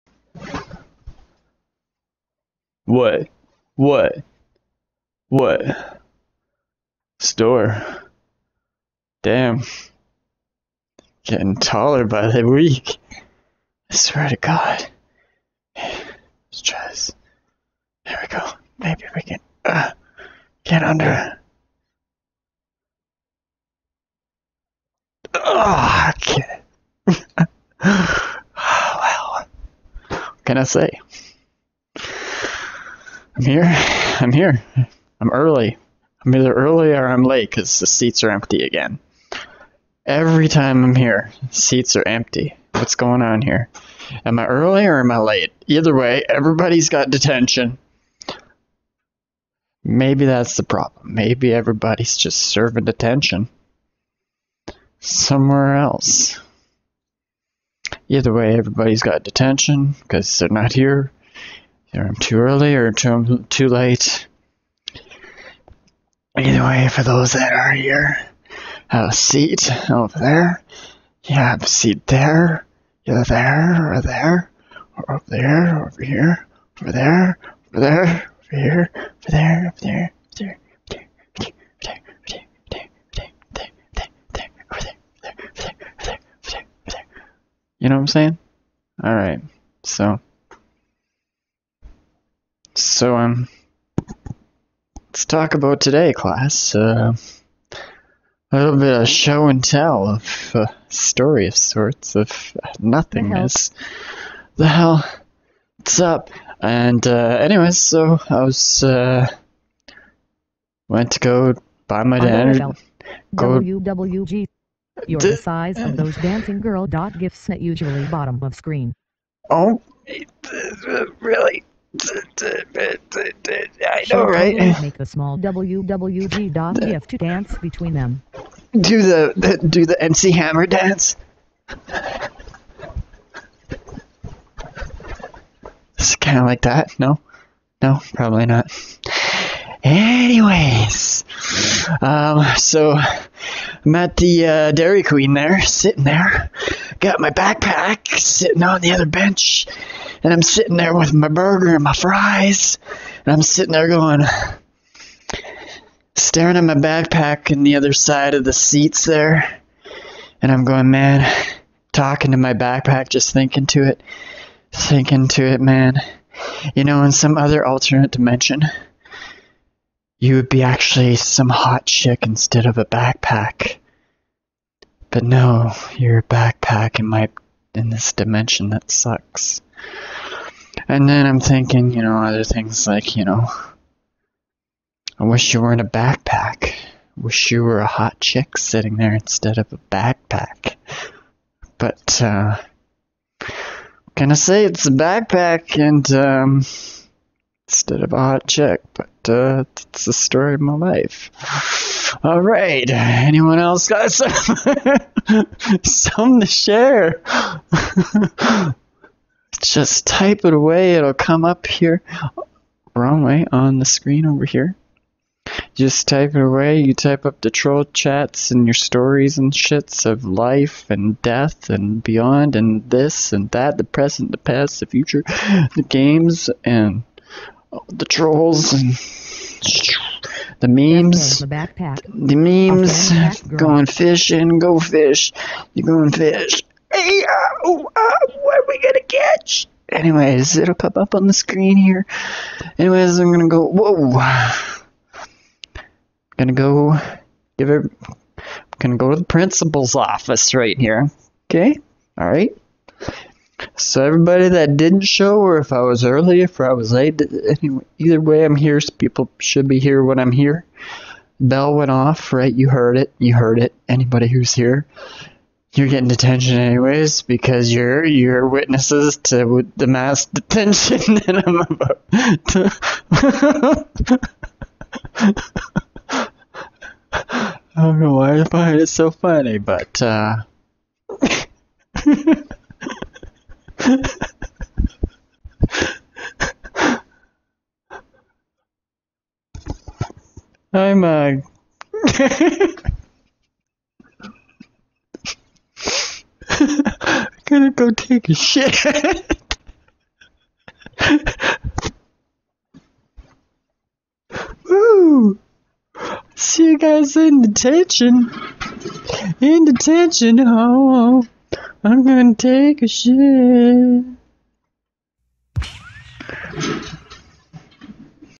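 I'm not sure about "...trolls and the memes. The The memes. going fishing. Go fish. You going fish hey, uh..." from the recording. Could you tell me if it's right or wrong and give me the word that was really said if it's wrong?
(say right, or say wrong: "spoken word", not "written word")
right.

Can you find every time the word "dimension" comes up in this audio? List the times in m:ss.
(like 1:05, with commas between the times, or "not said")
2:48, 2:58.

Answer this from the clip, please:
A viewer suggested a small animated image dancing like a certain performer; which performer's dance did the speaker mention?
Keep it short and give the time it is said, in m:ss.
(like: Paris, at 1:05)
MC Hammer, at 2:10.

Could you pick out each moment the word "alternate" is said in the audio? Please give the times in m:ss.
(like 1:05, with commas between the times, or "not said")
2:47.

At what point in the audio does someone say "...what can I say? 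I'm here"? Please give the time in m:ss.
0:29.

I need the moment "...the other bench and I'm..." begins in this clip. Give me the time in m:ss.
2:28.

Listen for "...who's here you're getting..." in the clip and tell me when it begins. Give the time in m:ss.
4:24.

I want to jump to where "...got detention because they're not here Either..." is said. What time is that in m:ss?
0:59.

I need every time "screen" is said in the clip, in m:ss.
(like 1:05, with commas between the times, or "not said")
1:58, 3:33, 4:01.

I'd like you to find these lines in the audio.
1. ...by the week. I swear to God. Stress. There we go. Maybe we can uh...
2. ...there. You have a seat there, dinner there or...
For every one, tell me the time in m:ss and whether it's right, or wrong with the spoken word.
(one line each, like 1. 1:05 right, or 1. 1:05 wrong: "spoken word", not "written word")
1. 0:12 right
2. 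1:10 wrong: "either", not "dinner".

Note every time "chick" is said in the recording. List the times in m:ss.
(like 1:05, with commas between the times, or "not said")
2:51, 3:08, 3:18.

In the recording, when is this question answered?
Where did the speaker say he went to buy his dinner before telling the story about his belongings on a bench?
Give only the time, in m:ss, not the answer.
2:24.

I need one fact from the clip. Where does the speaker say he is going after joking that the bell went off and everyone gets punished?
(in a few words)
The principal's office.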